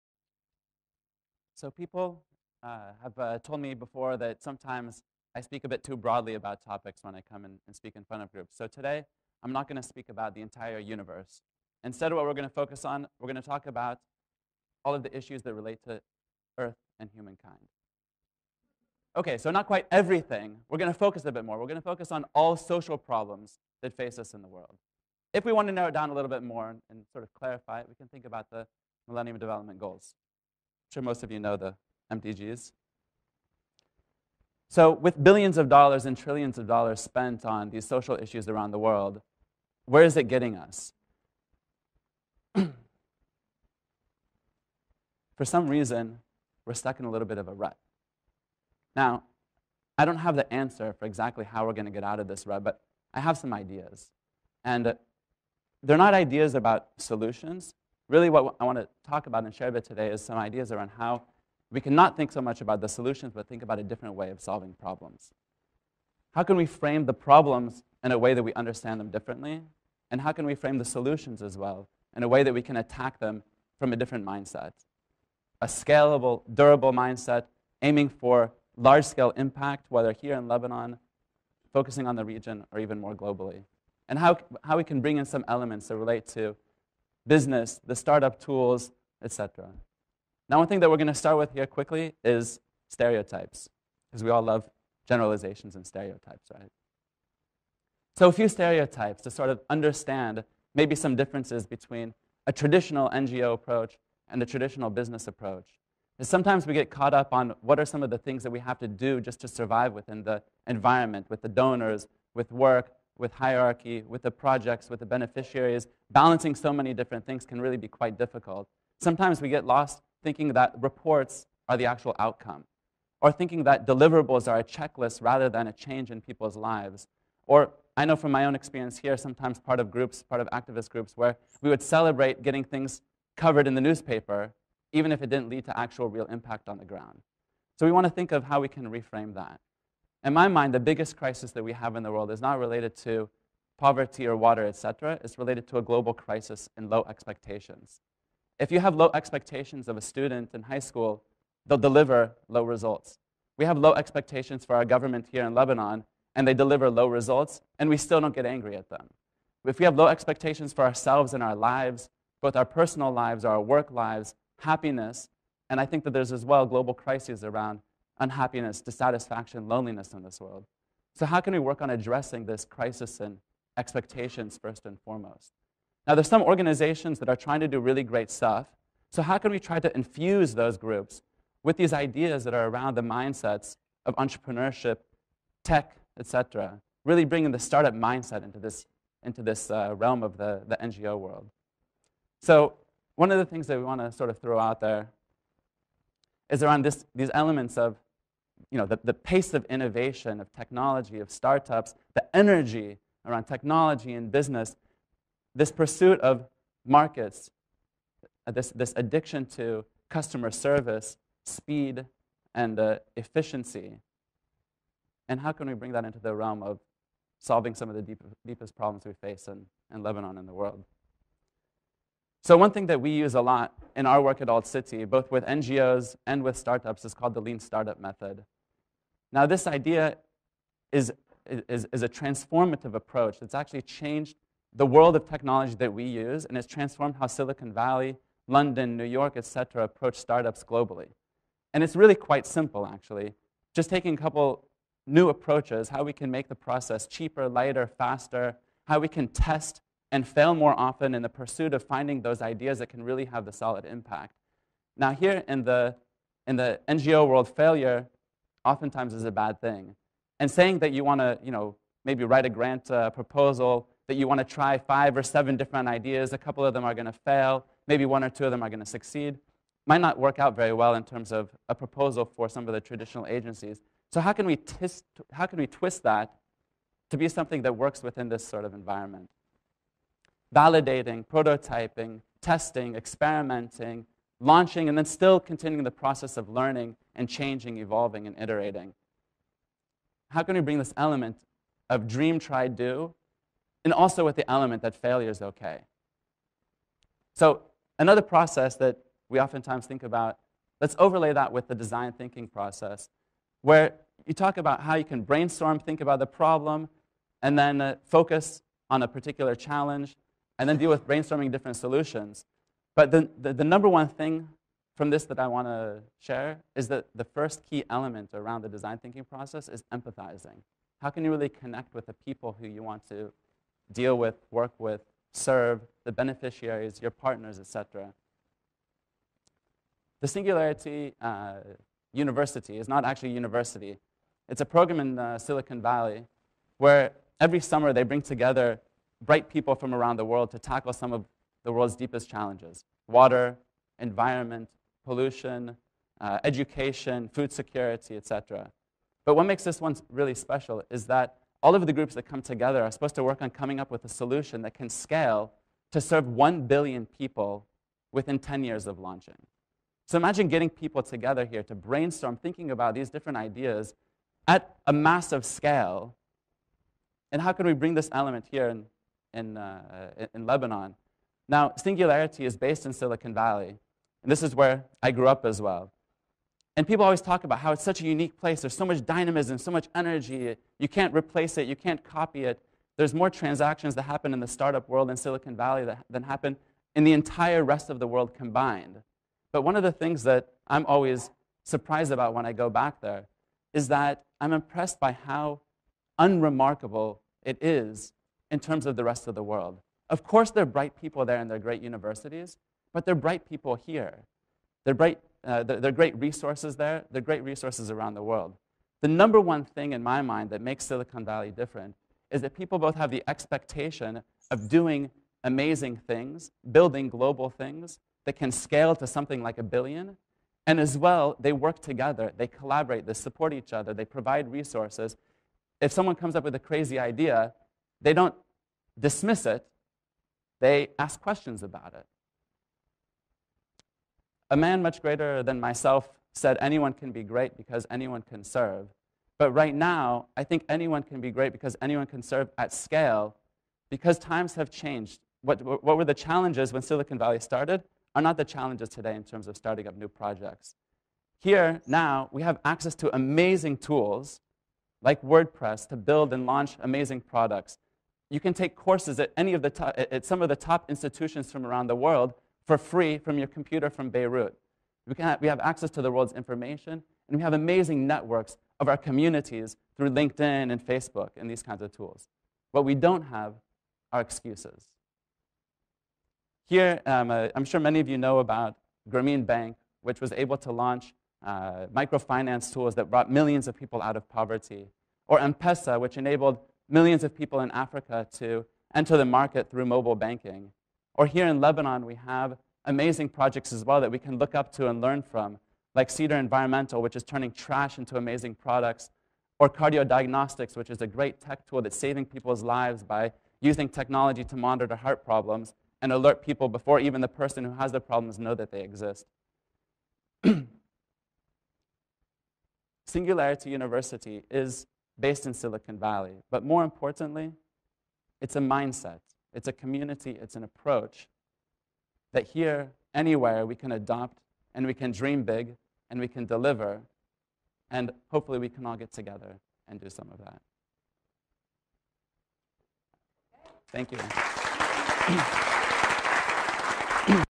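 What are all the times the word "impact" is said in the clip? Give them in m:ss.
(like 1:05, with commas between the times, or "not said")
1:19, 2:16, 4:13.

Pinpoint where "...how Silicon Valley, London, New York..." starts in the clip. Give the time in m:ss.
3:57.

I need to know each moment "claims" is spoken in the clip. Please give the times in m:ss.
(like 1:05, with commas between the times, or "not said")
not said.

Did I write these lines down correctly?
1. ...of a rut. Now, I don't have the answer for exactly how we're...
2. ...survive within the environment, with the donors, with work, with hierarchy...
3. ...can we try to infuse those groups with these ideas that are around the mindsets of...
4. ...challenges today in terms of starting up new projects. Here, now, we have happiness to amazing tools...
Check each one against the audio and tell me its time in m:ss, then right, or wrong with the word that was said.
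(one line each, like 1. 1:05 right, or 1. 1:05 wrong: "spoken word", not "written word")
1. 0:47 right
2. 1:49 right
3. 2:59 right
4. 7:28 wrong: "access", not "happiness".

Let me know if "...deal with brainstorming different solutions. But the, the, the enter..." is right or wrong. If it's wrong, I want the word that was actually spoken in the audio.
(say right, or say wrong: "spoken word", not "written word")
wrong: "number", not "enter".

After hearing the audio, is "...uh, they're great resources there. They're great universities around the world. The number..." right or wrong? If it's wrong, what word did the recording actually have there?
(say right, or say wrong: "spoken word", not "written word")
wrong: "resources", not "universities".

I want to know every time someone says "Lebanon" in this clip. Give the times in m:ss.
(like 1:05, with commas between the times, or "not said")
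1:20, 2:35, 3:40, 6:10, 8:11.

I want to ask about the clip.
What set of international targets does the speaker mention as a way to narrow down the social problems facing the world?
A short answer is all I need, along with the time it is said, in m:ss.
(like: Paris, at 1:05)
Millennium Development Goals, at 0:29.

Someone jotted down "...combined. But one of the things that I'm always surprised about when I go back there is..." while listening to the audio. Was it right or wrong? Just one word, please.
right.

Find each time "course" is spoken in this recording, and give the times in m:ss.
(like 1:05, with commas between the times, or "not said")
6:40, 7:38.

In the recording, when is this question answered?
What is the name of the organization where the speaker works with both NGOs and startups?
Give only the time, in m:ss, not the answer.
3:44.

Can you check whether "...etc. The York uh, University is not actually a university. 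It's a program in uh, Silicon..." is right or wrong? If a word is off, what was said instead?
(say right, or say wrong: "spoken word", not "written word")
wrong: "Singularity", not "York".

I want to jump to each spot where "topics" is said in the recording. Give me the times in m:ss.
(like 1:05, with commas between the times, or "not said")
0:06.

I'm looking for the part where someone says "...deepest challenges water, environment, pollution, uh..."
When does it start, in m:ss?
5:41.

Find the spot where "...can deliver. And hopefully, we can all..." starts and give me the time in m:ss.
8:46.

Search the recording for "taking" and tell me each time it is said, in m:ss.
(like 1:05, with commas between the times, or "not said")
4:03.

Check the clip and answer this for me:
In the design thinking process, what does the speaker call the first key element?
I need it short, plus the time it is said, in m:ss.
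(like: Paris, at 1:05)
empathizing, at 5:19.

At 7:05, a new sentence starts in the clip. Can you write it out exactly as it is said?
If someone comes up with a crazy idea, they don't dismiss it, they ask questions about it.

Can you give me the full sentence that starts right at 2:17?
So we want to think of how we can reframe that.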